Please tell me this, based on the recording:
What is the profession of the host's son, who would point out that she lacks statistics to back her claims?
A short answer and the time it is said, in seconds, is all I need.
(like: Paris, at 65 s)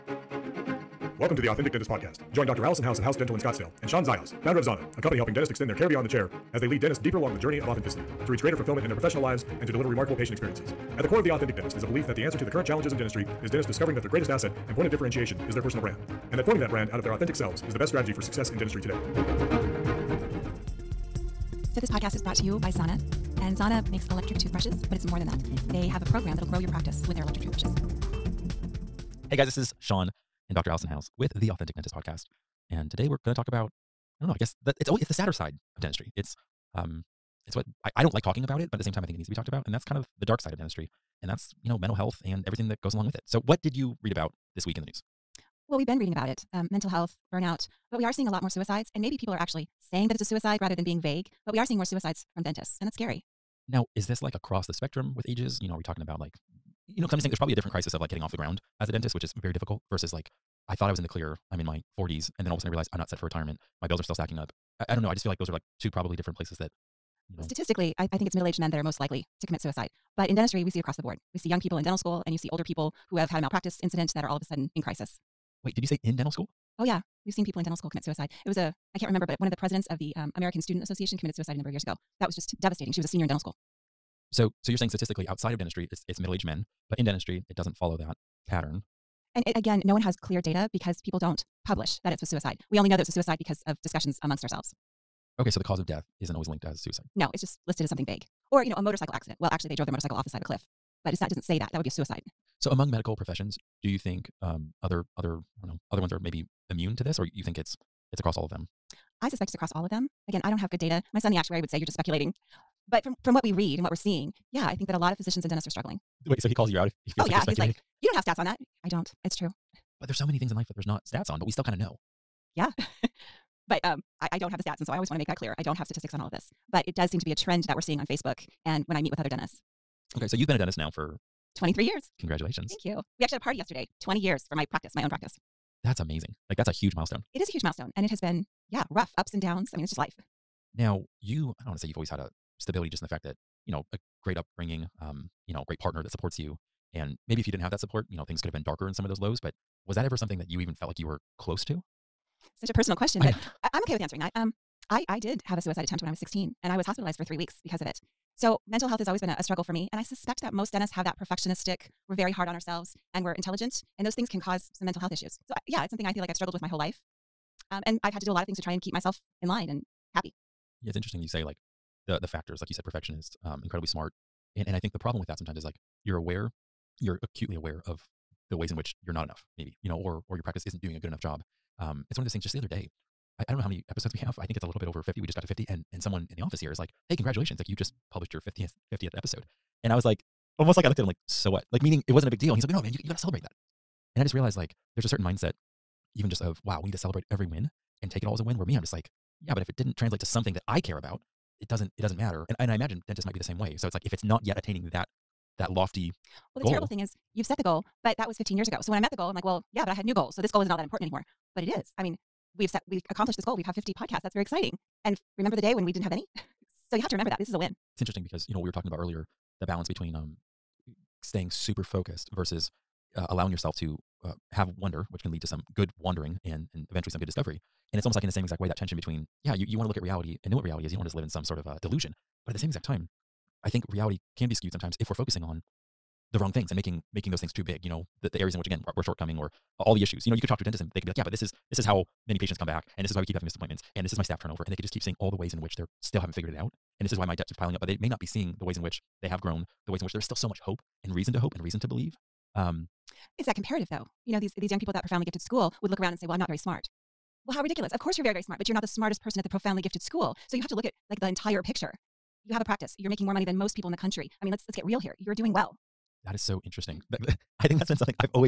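Actuary, at 111 s.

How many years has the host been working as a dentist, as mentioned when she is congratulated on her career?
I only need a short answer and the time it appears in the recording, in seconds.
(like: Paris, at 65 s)
23, at 131 s.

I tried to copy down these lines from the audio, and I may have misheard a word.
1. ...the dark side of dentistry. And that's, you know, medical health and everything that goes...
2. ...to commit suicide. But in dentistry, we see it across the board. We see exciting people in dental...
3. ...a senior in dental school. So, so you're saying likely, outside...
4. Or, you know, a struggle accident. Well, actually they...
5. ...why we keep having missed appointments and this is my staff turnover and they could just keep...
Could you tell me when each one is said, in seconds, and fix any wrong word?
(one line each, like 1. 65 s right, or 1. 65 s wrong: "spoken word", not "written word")
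1. 40 s wrong: "mental", not "medical"
2. 69 s wrong: "young", not "exciting"
3. 83 s wrong: "statistically", not "likely"
4. 98 s wrong: "motorcycle", not "struggle"
5. 243 s right.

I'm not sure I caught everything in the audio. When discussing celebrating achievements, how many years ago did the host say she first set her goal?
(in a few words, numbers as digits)
15.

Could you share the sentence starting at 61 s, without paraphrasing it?
I'm in my 40s, and then all of a sudden I realize I'm not set for retirement.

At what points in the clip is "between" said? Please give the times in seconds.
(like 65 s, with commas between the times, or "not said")
219 s, 228 s.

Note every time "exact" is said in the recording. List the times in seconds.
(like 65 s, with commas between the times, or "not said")
228 s, 232 s.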